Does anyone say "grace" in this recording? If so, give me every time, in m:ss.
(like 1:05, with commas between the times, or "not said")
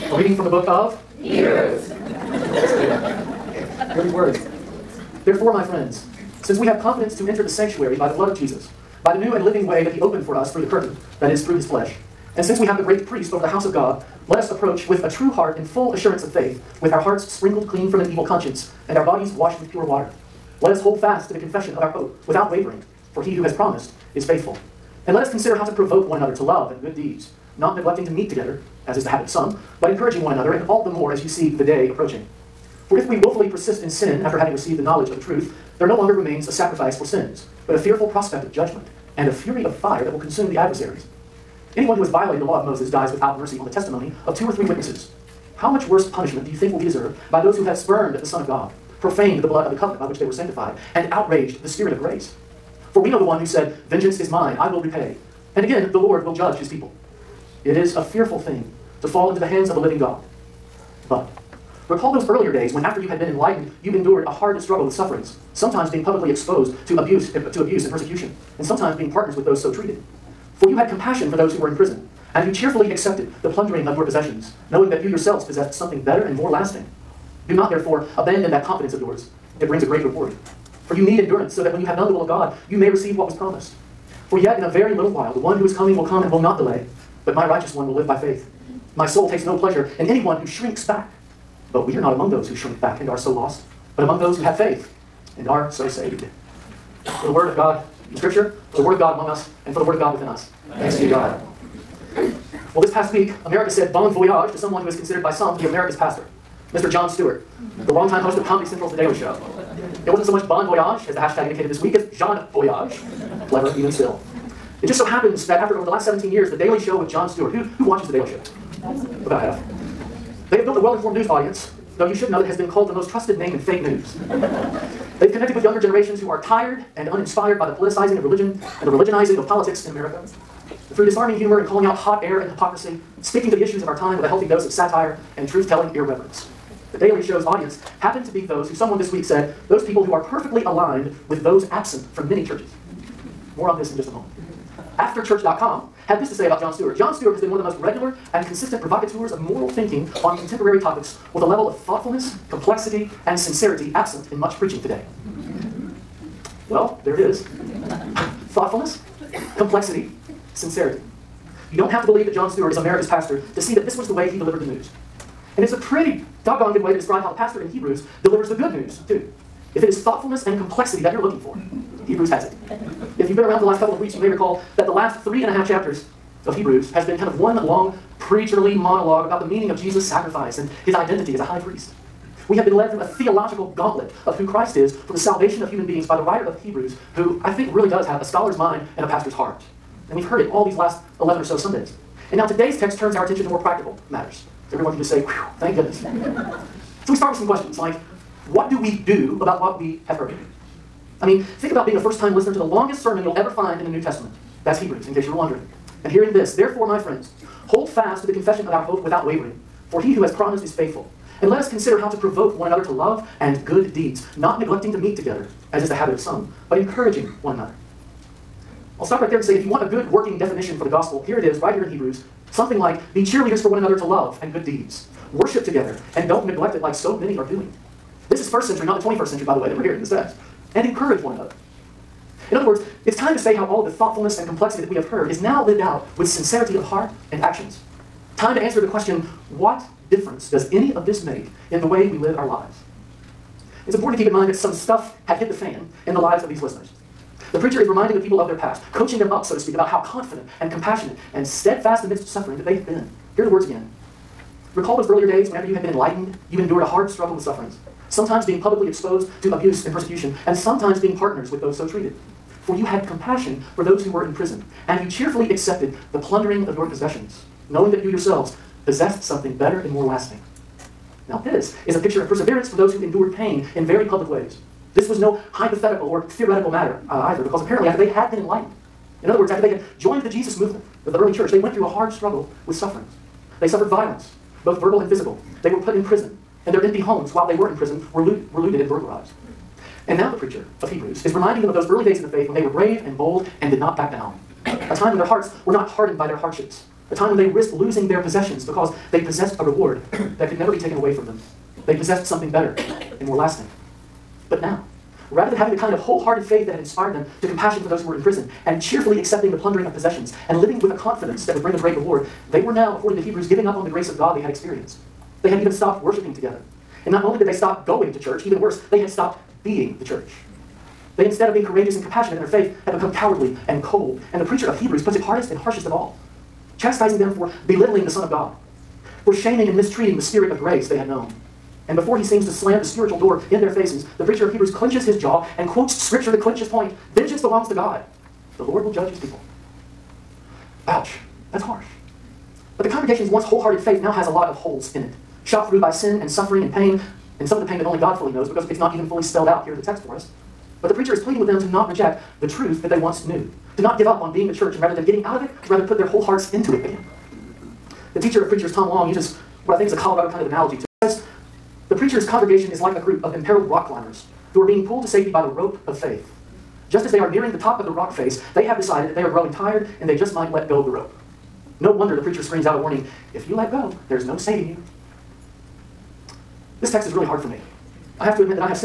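0:51, 5:13, 5:30.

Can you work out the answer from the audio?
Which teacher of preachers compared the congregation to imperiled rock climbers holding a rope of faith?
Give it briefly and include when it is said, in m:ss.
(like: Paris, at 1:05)
Tom Long, at 5:58.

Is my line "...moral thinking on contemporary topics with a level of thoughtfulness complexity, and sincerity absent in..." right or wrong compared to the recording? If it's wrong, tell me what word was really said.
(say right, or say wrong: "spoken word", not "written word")
right.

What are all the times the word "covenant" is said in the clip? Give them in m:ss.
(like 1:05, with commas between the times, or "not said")
0:49.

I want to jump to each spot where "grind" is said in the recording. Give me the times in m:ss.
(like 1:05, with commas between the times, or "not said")
not said.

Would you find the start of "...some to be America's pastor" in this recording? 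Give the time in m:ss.
1:45.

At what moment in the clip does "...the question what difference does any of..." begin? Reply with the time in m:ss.
3:58.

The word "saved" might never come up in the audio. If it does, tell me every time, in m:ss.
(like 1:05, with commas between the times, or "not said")
1:35.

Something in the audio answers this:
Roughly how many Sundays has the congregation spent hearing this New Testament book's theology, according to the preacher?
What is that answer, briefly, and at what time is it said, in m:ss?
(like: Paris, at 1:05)
11, at 3:11.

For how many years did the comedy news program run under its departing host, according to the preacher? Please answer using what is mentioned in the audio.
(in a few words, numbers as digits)
17.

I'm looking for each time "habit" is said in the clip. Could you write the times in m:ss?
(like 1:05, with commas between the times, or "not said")
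0:29, 3:35.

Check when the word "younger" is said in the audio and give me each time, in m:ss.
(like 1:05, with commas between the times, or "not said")
2:05.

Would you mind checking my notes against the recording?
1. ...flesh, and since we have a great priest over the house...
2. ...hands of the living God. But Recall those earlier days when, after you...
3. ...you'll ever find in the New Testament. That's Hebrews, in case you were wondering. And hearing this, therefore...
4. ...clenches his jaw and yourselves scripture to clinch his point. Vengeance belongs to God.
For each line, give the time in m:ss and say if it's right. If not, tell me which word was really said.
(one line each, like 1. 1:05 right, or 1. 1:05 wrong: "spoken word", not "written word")
1. 0:11 right
2. 0:59 right
3. 3:23 right
4. 5:34 wrong: "quotes", not "yourselves".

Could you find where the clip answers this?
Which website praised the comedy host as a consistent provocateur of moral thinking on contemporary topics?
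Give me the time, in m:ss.
2:24.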